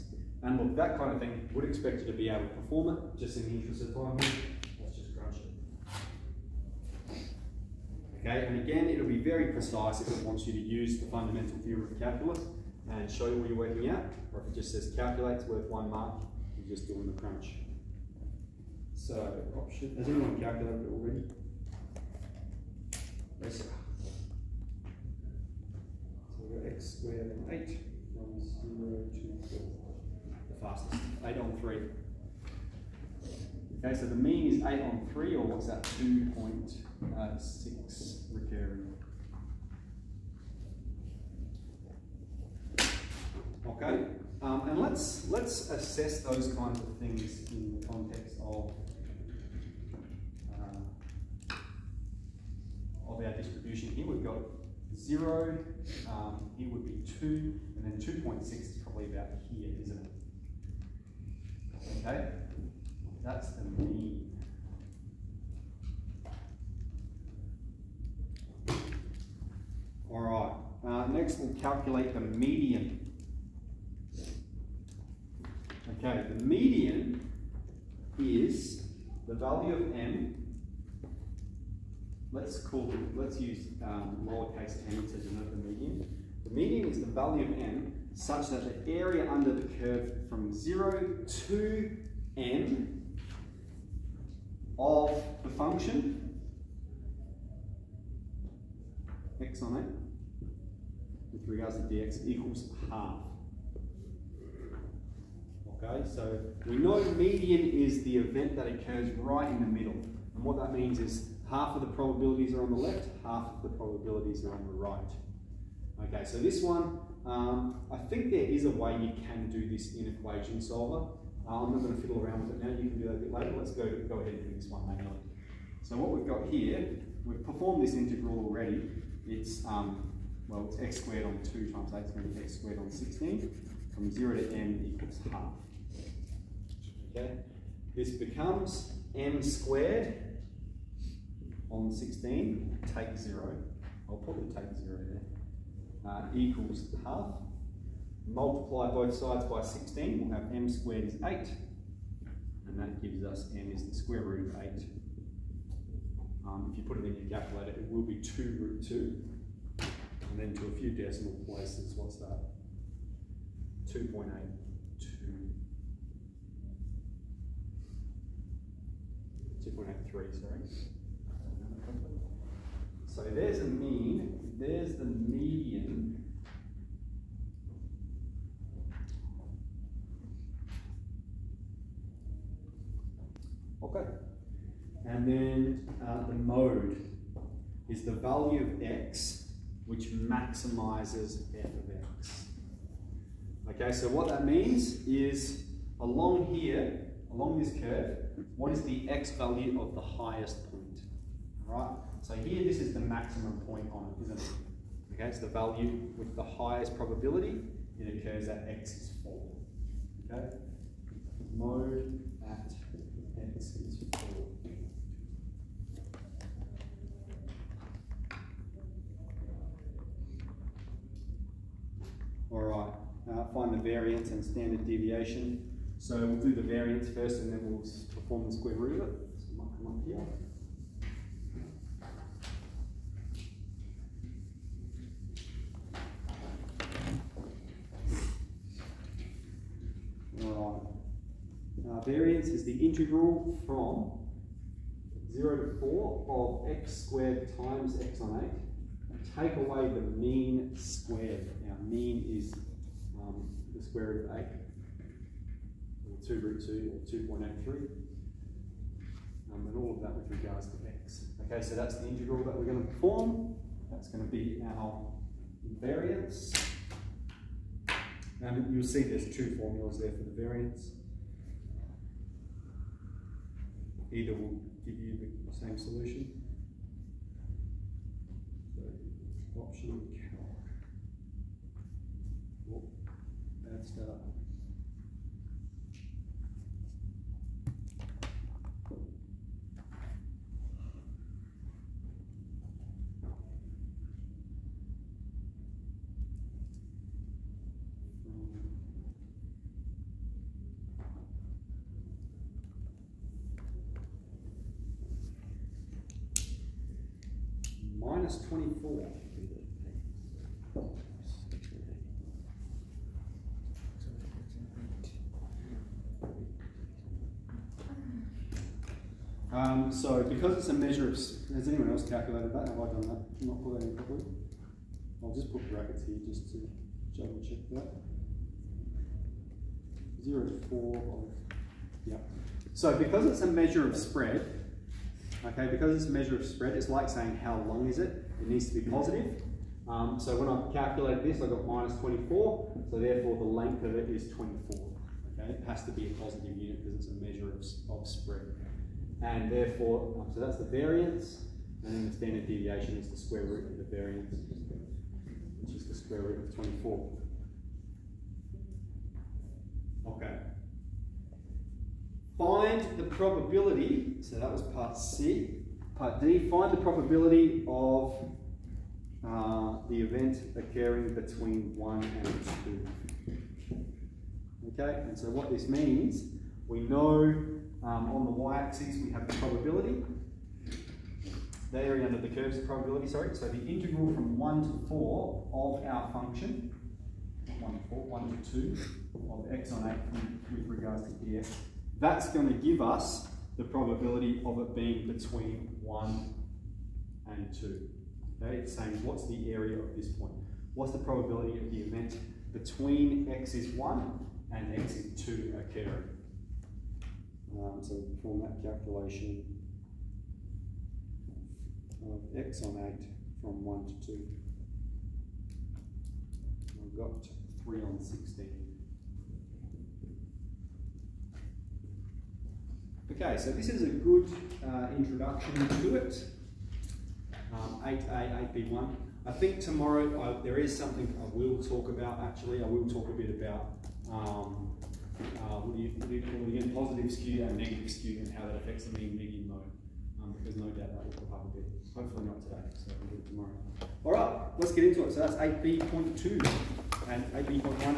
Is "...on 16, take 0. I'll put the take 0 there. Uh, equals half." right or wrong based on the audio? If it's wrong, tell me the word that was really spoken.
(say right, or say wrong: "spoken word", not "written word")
right.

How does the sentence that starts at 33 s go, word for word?
Okay, so the mean is 8 on 3, or what's that, 2.6 uh, recurring?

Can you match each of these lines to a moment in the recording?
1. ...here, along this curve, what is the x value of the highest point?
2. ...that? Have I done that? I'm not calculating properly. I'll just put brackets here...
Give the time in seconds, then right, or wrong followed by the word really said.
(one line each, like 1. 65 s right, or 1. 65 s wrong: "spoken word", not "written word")
1. 196 s right
2. 322 s right.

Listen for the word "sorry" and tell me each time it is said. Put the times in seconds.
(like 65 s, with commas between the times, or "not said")
170 s, 383 s.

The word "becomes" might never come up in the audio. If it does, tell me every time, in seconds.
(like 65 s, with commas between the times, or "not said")
138 s.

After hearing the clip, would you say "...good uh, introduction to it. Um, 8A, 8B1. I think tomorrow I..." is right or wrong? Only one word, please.
right.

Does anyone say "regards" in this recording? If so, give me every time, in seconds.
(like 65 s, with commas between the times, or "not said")
101 s, 260 s, 390 s.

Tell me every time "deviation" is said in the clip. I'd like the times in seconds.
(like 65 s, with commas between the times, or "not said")
224 s, 352 s.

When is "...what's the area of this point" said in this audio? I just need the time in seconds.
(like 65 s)
399 s.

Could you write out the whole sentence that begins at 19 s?
So option, oh, has anyone calculated it already?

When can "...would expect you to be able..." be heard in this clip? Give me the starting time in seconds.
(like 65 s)
1 s.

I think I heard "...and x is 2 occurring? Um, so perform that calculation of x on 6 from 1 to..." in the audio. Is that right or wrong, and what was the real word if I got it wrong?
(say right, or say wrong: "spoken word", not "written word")
wrong: "8", not "6".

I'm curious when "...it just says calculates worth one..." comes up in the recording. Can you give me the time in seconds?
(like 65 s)
14 s.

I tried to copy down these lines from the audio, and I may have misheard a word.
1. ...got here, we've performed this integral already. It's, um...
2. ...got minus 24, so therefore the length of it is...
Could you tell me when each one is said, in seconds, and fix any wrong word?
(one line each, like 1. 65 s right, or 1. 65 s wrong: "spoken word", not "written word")
1. 126 s right
2. 341 s right.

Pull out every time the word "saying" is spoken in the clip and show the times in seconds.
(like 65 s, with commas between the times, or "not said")
337 s, 398 s.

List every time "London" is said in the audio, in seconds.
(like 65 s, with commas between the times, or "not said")
not said.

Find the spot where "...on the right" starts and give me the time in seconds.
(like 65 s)
114 s.